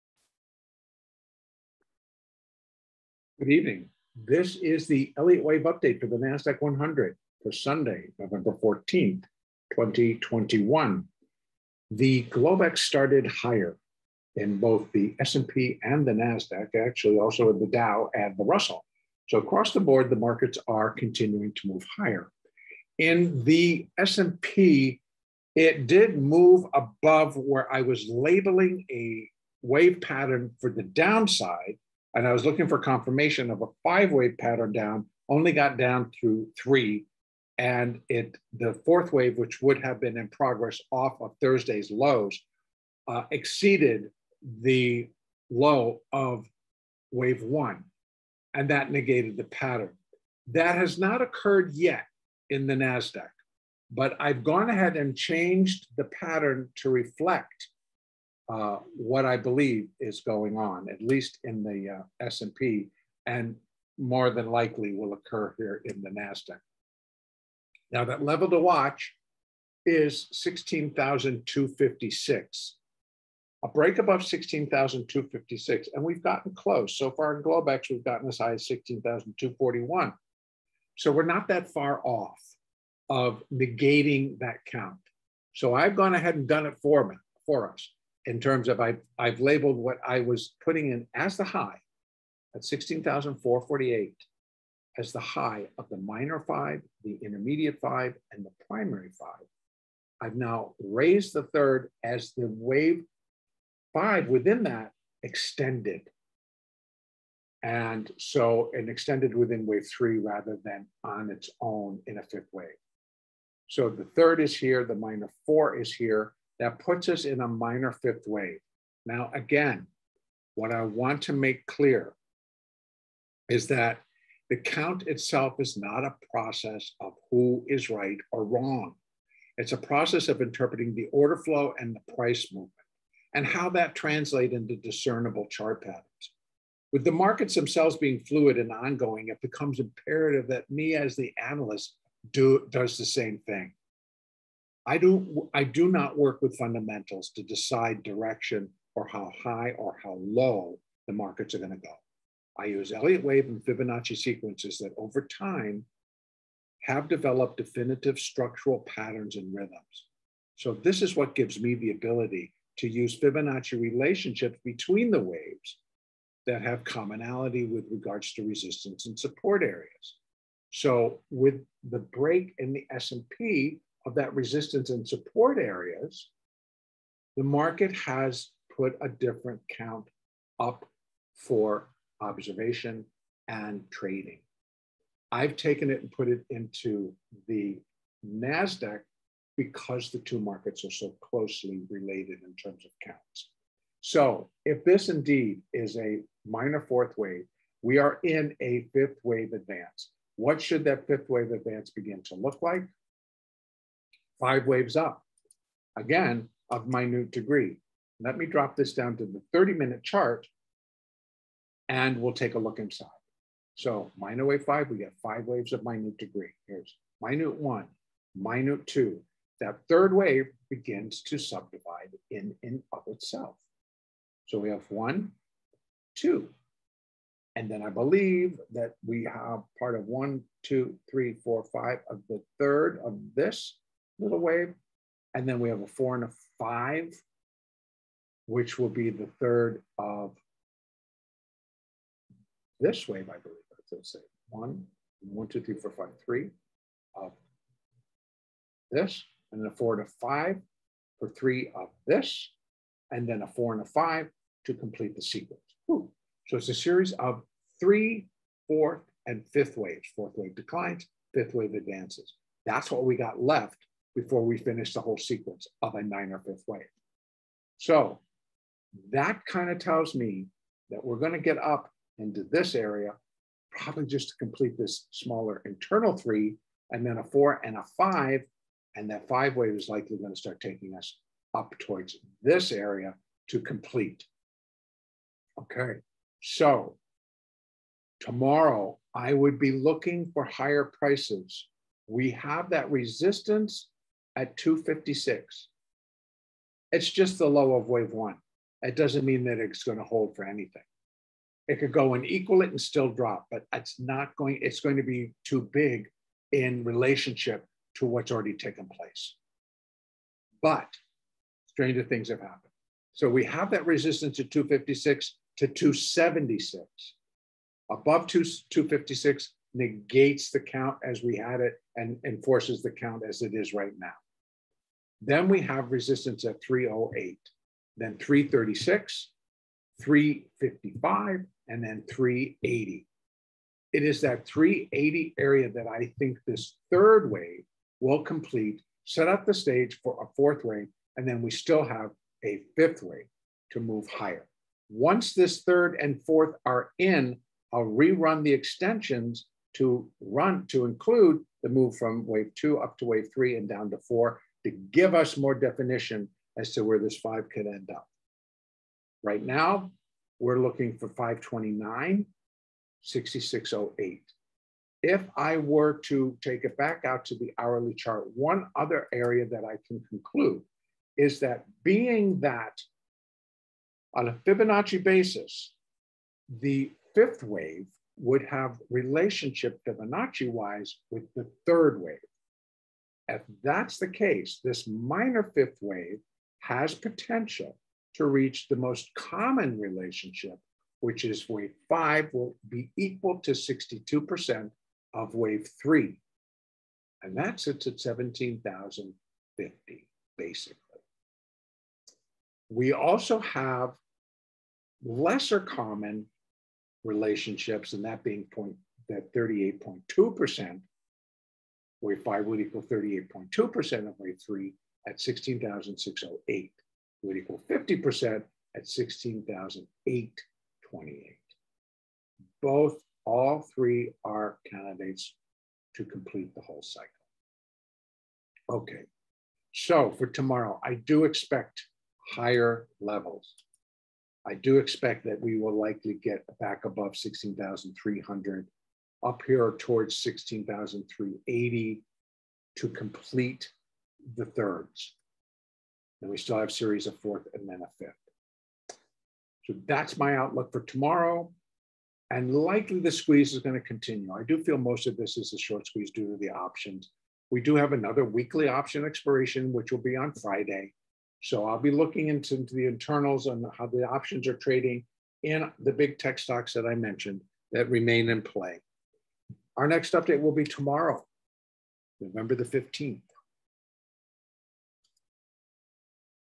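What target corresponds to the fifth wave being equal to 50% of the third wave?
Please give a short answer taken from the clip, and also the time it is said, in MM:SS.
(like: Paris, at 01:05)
16,828, at 06:58.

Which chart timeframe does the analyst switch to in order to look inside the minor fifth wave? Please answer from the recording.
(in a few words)
30 minute chart.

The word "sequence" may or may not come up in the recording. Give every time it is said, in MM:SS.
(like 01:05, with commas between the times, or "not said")
02:34, 04:15, 04:25.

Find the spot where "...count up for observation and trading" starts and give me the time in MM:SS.
02:59.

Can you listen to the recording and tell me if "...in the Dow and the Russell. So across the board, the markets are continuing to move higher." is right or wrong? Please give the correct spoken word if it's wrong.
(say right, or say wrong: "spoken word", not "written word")
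right.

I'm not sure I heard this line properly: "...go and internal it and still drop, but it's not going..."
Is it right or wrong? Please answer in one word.
wrong.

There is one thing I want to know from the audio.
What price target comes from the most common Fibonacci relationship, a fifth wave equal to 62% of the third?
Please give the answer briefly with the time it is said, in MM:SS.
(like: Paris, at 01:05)
17,050, at 06:38.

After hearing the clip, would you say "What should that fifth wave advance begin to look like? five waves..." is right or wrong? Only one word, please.
right.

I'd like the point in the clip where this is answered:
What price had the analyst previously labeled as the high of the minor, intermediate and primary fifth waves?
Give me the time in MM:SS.
01:32.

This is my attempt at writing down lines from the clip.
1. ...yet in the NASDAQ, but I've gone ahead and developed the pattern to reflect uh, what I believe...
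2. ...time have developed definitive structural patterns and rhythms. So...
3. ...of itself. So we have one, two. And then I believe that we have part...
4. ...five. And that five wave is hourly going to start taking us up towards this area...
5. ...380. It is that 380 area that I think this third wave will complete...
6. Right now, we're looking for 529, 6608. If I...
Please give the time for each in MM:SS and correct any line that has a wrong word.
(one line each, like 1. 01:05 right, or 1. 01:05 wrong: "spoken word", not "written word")
1. 00:51 wrong: "changed", not "developed"
2. 02:35 right
3. 03:42 right
4. 04:37 wrong: "likely", not "hourly"
5. 05:32 right
6. 05:59 right.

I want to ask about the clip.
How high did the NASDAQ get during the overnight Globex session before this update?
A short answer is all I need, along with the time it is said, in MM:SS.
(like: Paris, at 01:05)
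16,241, at 01:18.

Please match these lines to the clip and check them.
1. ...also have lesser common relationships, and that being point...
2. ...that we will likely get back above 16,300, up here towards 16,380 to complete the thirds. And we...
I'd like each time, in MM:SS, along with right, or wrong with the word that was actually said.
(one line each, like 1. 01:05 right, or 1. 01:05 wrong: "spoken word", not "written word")
1. 06:42 right
2. 07:15 right.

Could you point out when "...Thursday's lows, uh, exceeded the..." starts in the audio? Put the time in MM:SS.
00:41.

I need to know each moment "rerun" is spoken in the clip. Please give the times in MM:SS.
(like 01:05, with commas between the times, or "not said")
05:47.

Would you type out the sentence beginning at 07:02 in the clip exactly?
Both, all three are candidates to complete the whole cycle.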